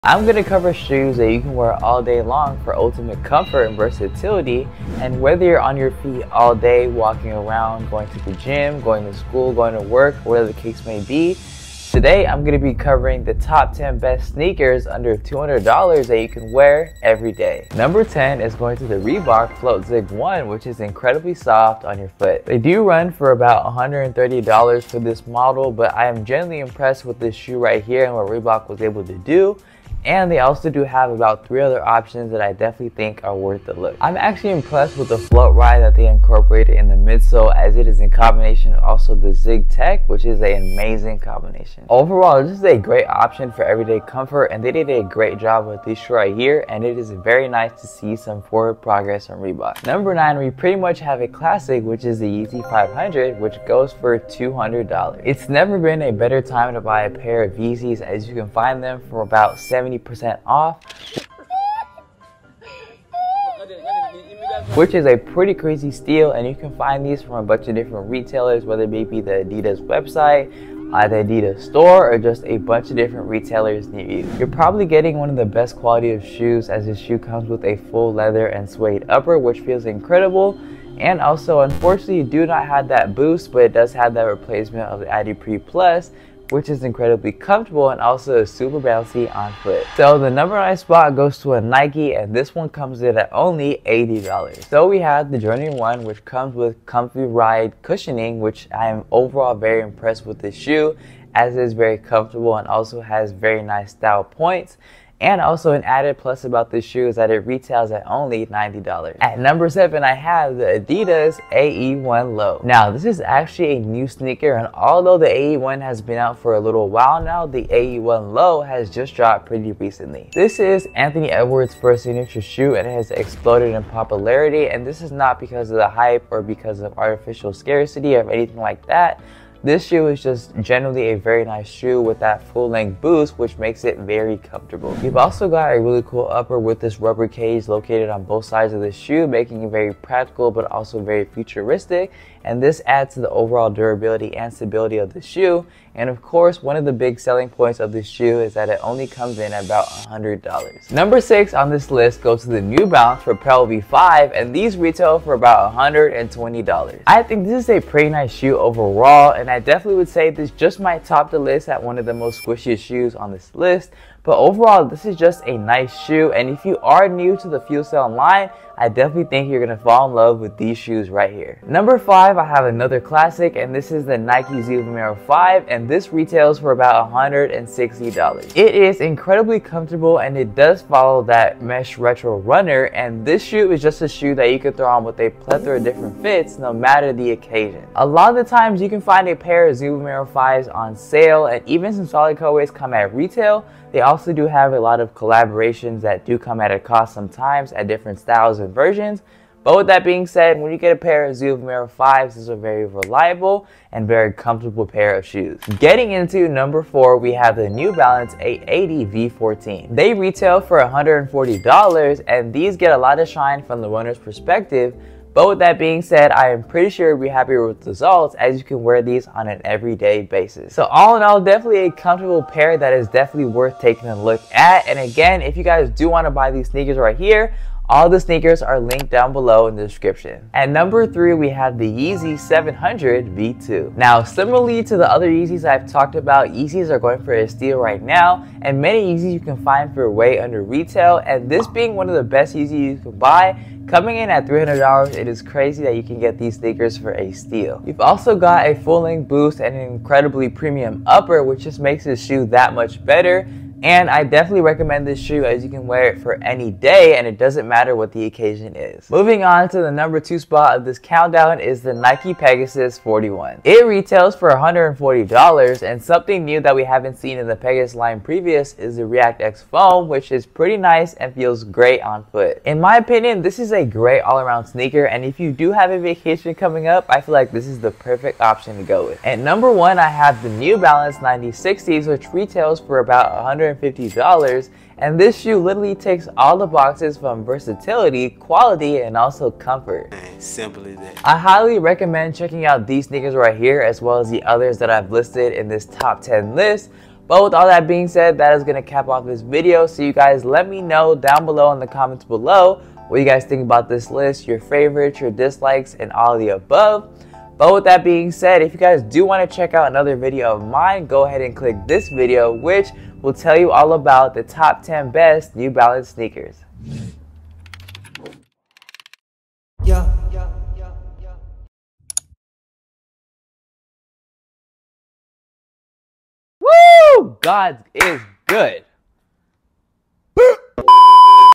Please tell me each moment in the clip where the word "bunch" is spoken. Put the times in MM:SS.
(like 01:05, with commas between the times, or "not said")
01:07, 01:12.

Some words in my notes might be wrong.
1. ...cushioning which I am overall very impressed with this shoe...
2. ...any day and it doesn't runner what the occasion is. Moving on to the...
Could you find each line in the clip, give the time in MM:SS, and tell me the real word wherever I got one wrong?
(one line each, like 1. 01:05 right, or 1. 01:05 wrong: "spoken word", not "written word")
1. 01:37 right
2. 04:16 wrong: "matter", not "runner".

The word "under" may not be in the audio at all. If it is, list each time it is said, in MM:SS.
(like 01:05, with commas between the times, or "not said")
00:14, 04:00.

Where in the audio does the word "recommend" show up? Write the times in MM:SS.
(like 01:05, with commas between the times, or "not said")
04:14, 04:51.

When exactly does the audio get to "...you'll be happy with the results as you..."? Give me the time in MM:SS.
03:37.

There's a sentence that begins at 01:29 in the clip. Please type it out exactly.
So the number I spot goes to a Nike and this one comes in at only $80.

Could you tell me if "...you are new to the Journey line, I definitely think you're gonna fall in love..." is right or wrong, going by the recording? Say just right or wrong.
wrong.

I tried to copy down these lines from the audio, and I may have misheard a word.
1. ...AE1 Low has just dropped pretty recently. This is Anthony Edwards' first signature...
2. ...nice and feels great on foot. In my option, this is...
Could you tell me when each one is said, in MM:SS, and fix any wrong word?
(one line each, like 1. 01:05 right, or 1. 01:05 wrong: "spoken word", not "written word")
1. 01:57 right
2. 04:30 wrong: "opinion", not "option".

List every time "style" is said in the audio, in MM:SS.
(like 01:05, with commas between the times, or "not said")
01:43, 03:18.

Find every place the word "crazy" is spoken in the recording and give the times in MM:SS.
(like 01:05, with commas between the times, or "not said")
01:05, 04:05.